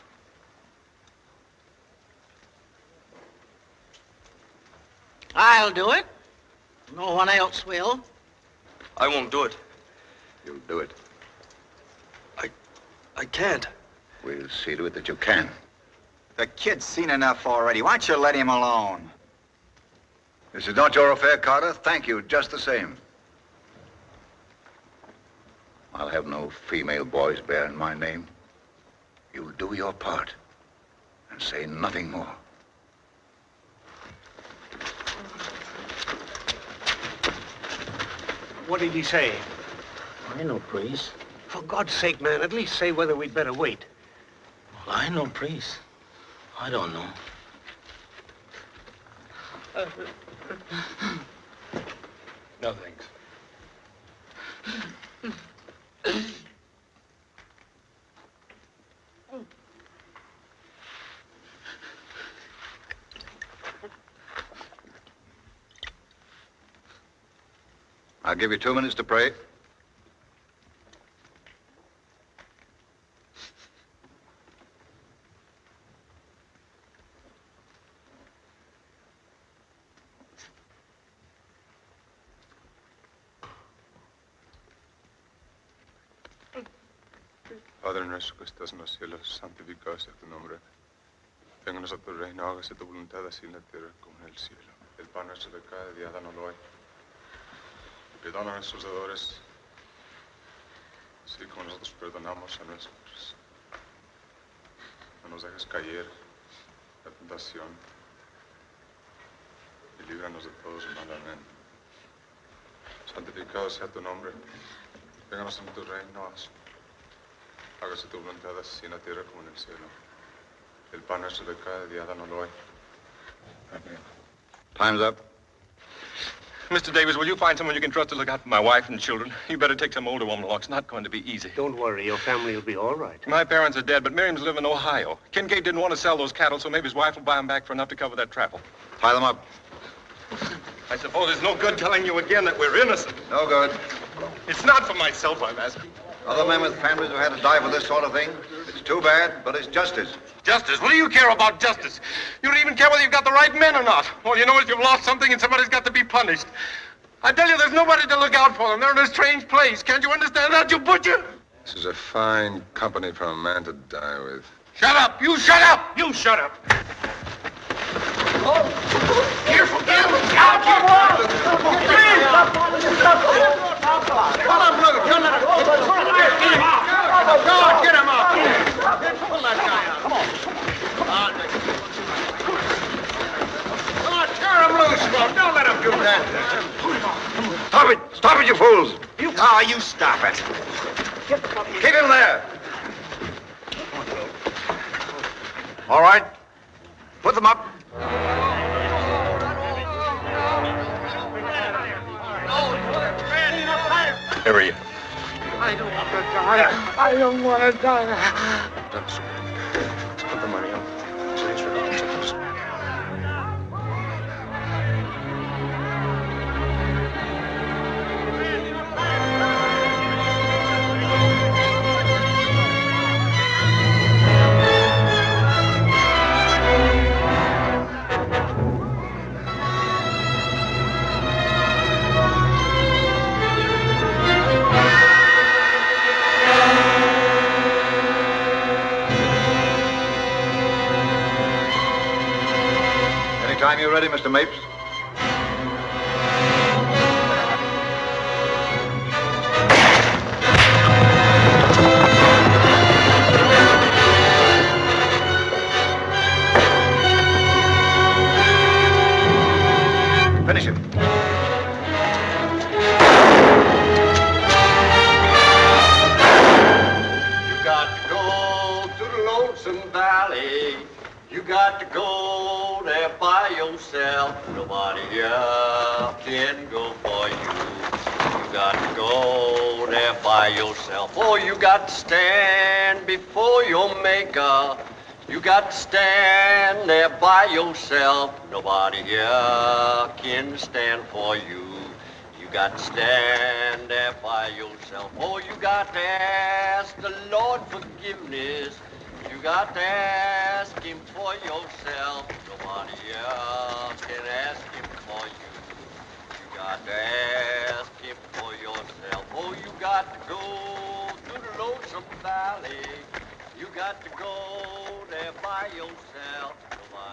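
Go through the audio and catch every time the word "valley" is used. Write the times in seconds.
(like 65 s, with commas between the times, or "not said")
269 s, 312 s.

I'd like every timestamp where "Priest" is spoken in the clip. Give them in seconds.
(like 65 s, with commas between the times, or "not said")
40 s, 45 s.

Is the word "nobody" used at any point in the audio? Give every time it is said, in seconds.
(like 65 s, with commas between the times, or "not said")
157 s, 274 s, 288 s, 302 s.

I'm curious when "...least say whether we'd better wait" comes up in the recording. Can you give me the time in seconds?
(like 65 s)
42 s.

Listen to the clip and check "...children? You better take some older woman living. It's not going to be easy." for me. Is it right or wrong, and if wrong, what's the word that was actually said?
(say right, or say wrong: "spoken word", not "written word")
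wrong: "along", not "living".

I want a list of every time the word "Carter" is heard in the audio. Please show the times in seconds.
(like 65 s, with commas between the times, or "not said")
21 s.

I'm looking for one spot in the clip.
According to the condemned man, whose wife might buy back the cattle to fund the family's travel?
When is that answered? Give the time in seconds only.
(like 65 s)
135 s.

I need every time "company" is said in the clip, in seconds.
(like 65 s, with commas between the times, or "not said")
162 s.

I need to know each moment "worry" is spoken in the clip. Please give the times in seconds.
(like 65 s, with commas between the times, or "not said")
131 s.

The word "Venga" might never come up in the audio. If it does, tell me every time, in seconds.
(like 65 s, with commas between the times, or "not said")
91 s, 115 s.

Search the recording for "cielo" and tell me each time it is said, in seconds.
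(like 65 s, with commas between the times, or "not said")
88 s, 94 s, 119 s.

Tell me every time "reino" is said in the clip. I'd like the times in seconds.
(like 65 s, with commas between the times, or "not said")
92 s, 115 s.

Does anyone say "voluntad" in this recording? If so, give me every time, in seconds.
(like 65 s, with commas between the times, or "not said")
92 s, 118 s.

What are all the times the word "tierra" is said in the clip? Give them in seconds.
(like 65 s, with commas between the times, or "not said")
93 s, 118 s.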